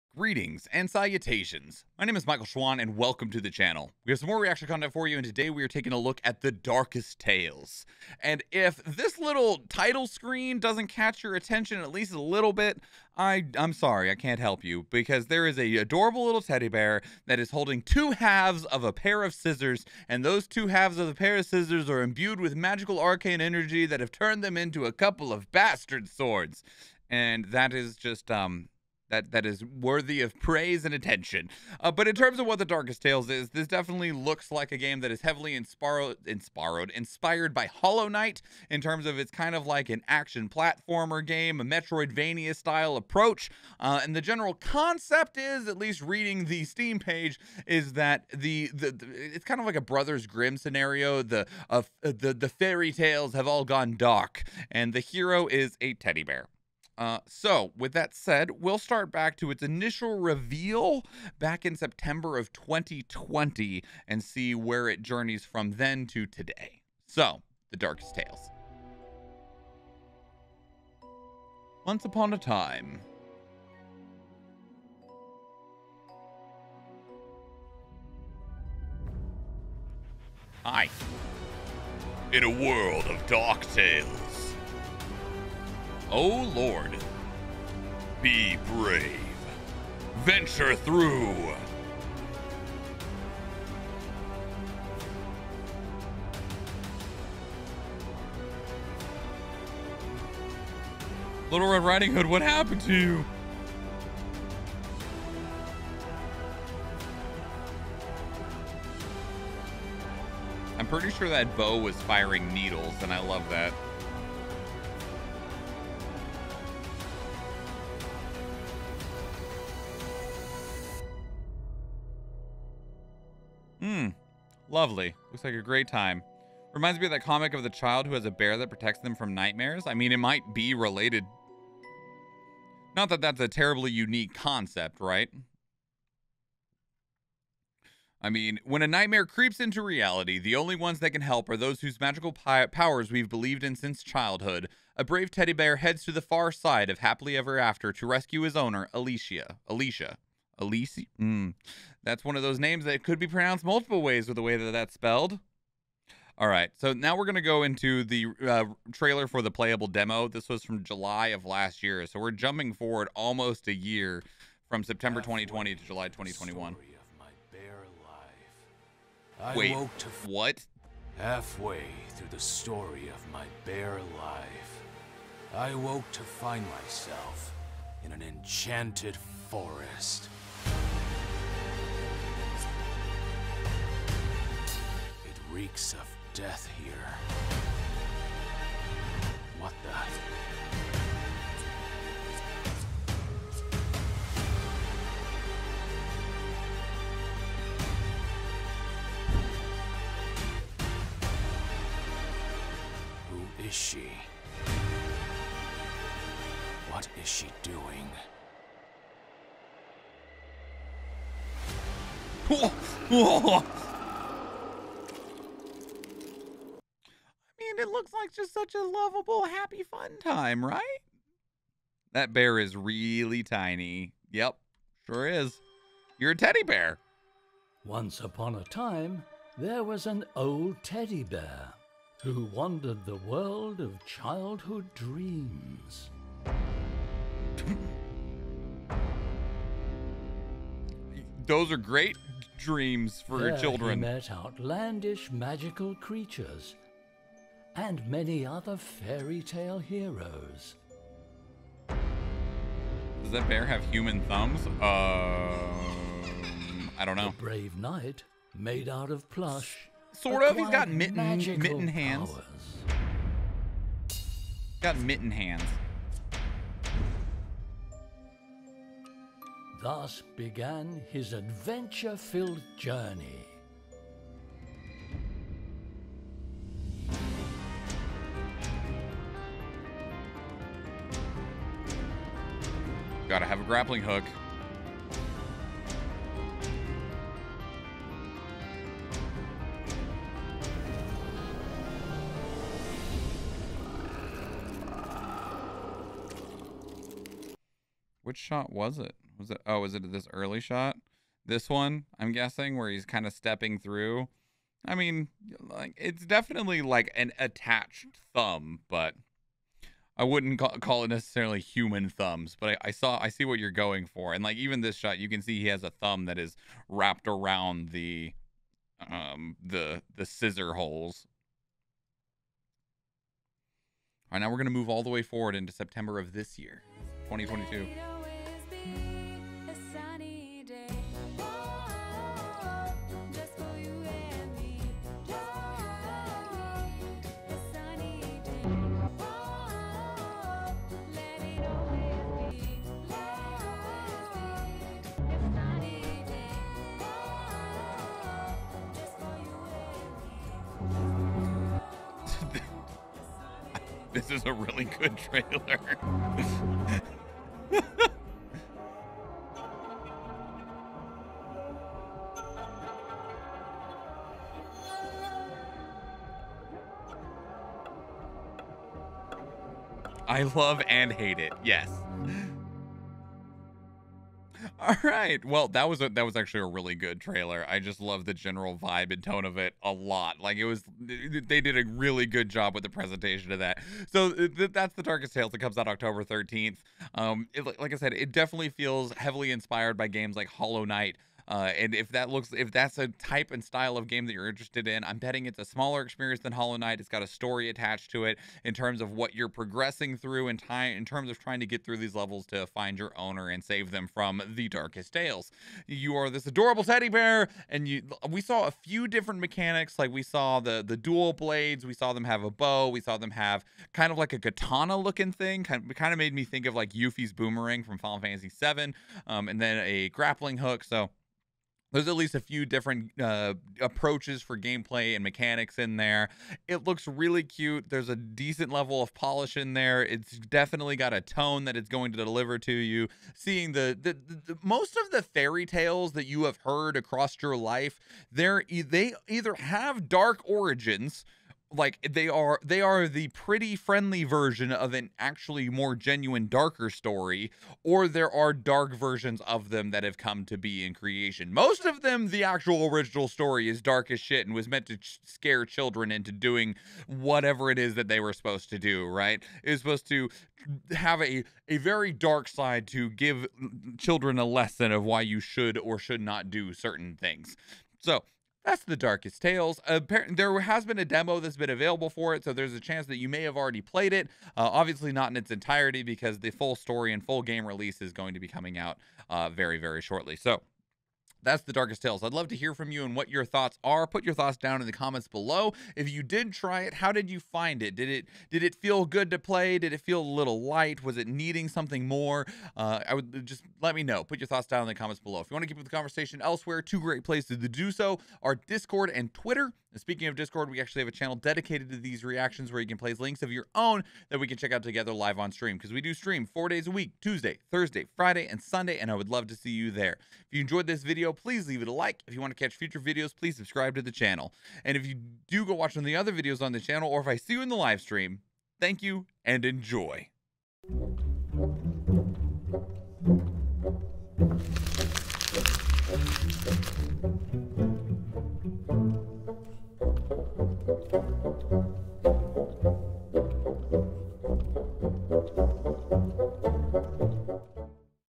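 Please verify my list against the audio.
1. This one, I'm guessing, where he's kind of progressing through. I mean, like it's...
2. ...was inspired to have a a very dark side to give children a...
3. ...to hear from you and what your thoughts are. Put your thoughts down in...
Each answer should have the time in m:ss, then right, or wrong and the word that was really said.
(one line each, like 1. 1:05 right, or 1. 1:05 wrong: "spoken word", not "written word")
1. 5:01 wrong: "stepping", not "progressing"
2. 7:39 wrong: "supposed", not "inspired"
3. 8:02 right.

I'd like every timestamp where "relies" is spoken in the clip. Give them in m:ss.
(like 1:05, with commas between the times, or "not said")
not said.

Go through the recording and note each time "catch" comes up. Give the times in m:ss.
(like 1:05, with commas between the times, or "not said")
0:10, 8:32.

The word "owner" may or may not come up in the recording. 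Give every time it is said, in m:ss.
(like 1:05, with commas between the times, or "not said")
2:28, 6:43.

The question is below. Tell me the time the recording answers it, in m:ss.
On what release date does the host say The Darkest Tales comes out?
6:25.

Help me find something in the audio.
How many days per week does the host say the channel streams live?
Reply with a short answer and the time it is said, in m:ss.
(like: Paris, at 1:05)
4, at 8:26.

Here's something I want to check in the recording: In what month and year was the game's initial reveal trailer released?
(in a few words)
September 2020.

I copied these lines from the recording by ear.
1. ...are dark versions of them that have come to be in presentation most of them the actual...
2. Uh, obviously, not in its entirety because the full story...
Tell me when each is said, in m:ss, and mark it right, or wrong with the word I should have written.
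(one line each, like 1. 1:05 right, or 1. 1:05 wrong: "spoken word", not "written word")
1. 7:28 wrong: "creation", not "presentation"
2. 7:54 right.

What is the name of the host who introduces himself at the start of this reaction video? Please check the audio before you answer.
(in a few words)
Michael Schwahn.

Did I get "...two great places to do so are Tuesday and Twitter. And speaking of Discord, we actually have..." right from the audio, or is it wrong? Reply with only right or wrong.
wrong.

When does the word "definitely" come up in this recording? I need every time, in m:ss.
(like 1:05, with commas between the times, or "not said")
0:33, 5:06, 6:28, 7:10.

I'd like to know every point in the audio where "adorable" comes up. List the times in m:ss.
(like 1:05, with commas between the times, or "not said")
0:15, 6:46.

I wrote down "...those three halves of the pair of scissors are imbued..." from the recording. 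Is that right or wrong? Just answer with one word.
wrong.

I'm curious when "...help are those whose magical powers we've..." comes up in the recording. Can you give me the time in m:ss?
2:21.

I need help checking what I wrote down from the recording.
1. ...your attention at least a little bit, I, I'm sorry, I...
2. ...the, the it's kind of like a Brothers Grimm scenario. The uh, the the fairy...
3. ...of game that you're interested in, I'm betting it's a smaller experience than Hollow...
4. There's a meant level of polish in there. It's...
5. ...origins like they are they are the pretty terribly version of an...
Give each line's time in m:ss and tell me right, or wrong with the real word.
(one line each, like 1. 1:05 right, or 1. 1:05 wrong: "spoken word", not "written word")
1. 0:11 right
2. 0:48 right
3. 6:33 right
4. 7:07 wrong: "decent", not "meant"
5. 7:20 wrong: "friendly", not "terribly".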